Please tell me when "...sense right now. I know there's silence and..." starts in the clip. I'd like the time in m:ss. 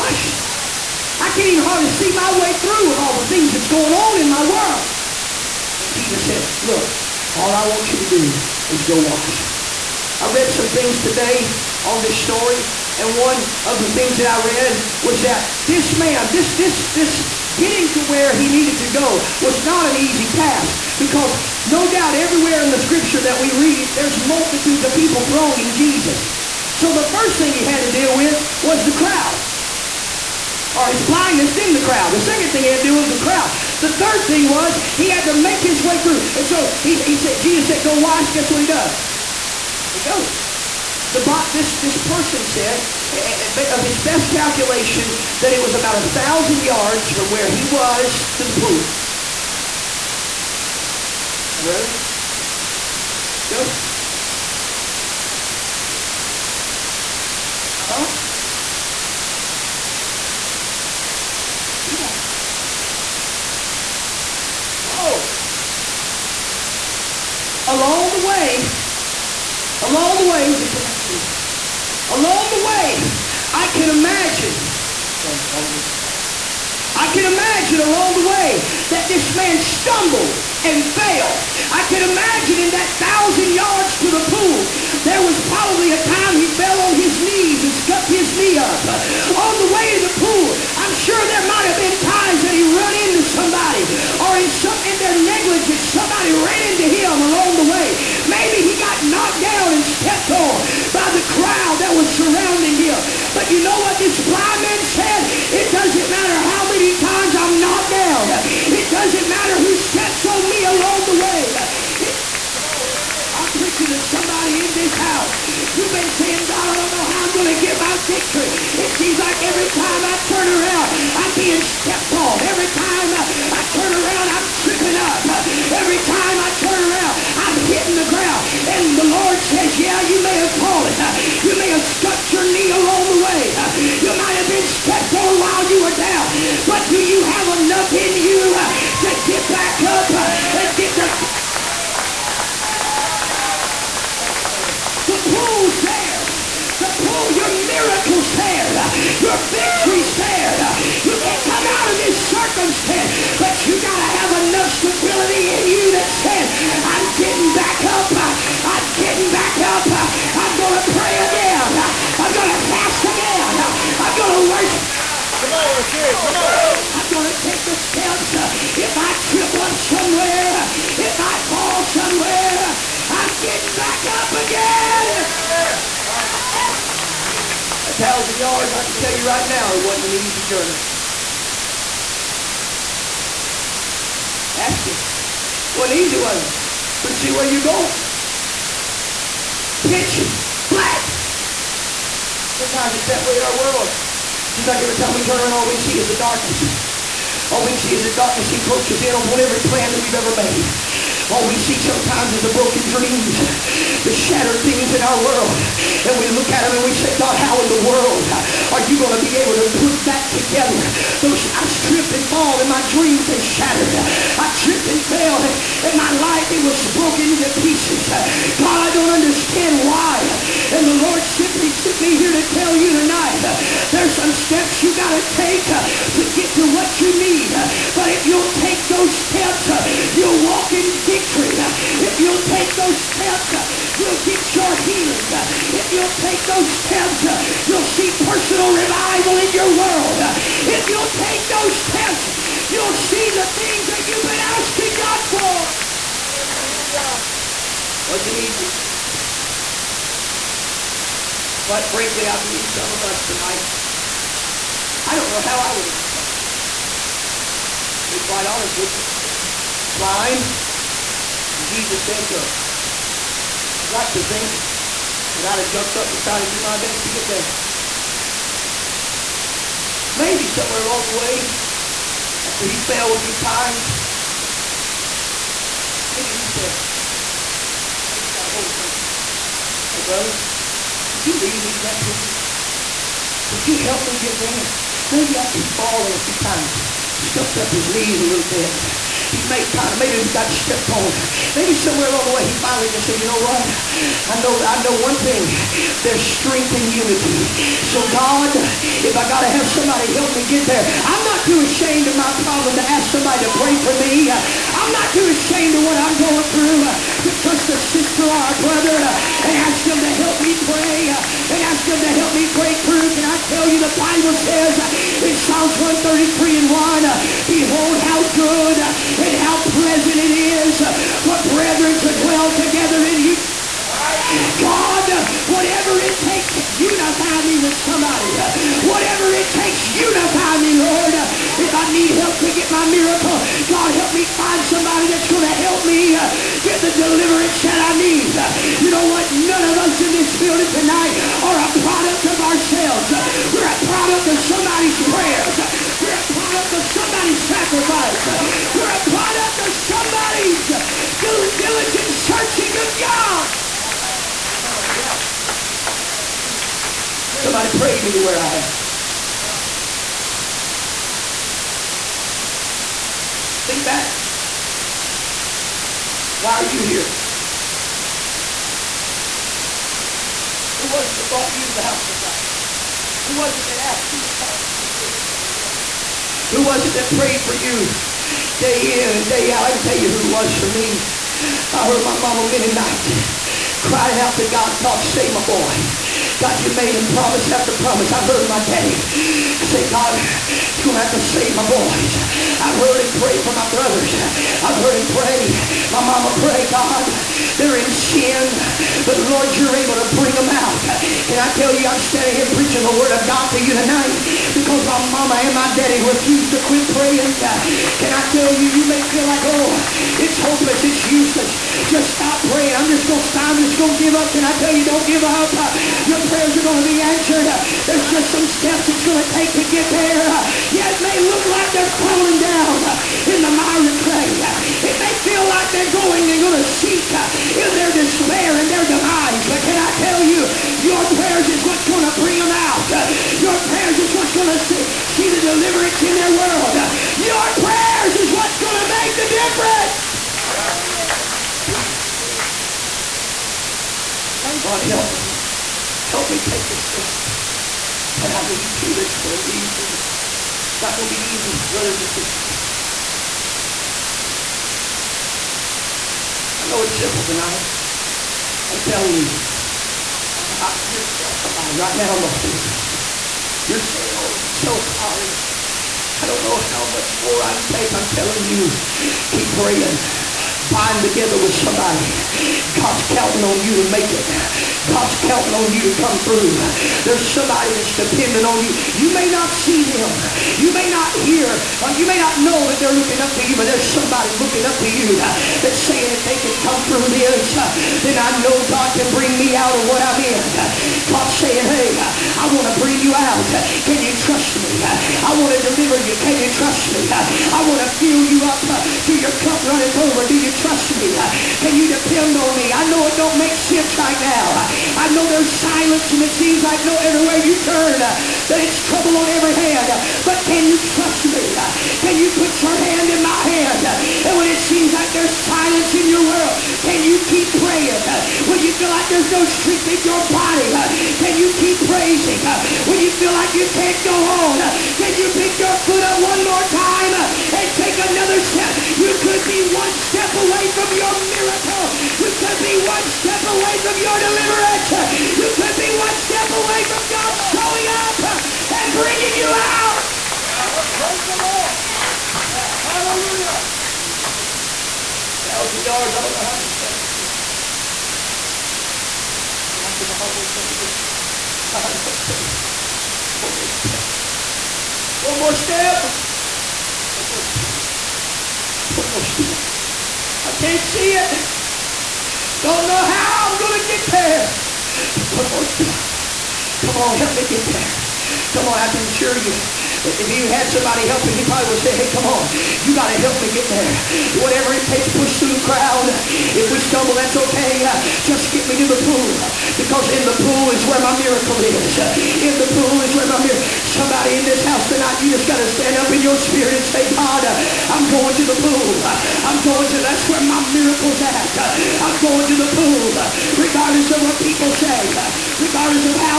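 8:23.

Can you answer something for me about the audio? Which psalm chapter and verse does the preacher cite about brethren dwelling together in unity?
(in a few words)
Psalms 133:1.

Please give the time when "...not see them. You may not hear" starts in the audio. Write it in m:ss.
7:59.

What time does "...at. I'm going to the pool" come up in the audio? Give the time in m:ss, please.
9:51.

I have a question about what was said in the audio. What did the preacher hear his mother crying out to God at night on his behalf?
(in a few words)
Save my boy.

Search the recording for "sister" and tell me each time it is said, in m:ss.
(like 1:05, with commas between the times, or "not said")
5:07, 7:32.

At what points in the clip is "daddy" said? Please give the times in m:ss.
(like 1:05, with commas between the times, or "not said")
6:28, 6:45.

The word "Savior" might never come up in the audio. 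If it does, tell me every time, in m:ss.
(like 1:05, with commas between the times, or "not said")
not said.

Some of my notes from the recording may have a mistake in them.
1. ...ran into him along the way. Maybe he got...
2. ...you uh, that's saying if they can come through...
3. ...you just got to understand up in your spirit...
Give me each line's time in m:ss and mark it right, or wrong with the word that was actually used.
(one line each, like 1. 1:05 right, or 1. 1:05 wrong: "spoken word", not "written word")
1. 1:36 right
2. 8:04 right
3. 9:45 wrong: "stand", not "understand".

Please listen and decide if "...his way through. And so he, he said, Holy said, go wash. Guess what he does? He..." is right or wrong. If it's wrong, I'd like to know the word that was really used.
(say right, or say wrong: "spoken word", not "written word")
wrong: "Jesus", not "Holy".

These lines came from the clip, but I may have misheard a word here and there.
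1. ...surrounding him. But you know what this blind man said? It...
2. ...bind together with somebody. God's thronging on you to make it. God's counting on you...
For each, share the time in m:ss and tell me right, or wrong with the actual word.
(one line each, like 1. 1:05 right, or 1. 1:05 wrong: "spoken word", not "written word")
1. 1:42 right
2. 7:50 wrong: "counting", not "thronging".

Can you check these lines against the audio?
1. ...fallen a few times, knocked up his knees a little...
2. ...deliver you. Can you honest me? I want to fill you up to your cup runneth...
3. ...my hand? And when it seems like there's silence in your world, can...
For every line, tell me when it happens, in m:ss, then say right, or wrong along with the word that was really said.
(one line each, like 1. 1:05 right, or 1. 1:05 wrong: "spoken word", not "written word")
1. 4:45 wrong: "scuffed", not "knocked"
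2. 8:15 wrong: "trust", not "honest"
3. 8:33 right.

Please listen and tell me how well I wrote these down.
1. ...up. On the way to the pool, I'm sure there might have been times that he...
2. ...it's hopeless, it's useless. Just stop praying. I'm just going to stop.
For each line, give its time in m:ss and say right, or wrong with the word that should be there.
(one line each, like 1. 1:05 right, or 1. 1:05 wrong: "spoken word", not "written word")
1. 1:28 right
2. 6:50 right.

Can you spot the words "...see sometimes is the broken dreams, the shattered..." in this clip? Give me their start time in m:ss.
3:21.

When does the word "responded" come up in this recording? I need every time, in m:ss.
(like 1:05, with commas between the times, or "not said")
4:15.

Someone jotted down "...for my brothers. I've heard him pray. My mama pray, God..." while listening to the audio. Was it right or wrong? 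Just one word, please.
right.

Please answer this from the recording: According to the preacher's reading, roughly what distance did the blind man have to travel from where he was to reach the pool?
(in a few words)
1,000 yards.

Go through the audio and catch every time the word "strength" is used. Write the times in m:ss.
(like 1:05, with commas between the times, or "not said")
4:56, 8:39.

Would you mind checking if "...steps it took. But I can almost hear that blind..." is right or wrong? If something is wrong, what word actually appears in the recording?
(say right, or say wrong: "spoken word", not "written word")
right.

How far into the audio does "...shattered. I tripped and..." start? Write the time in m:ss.
3:33.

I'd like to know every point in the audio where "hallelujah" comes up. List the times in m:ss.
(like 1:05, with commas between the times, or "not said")
4:06, 6:09, 9:02.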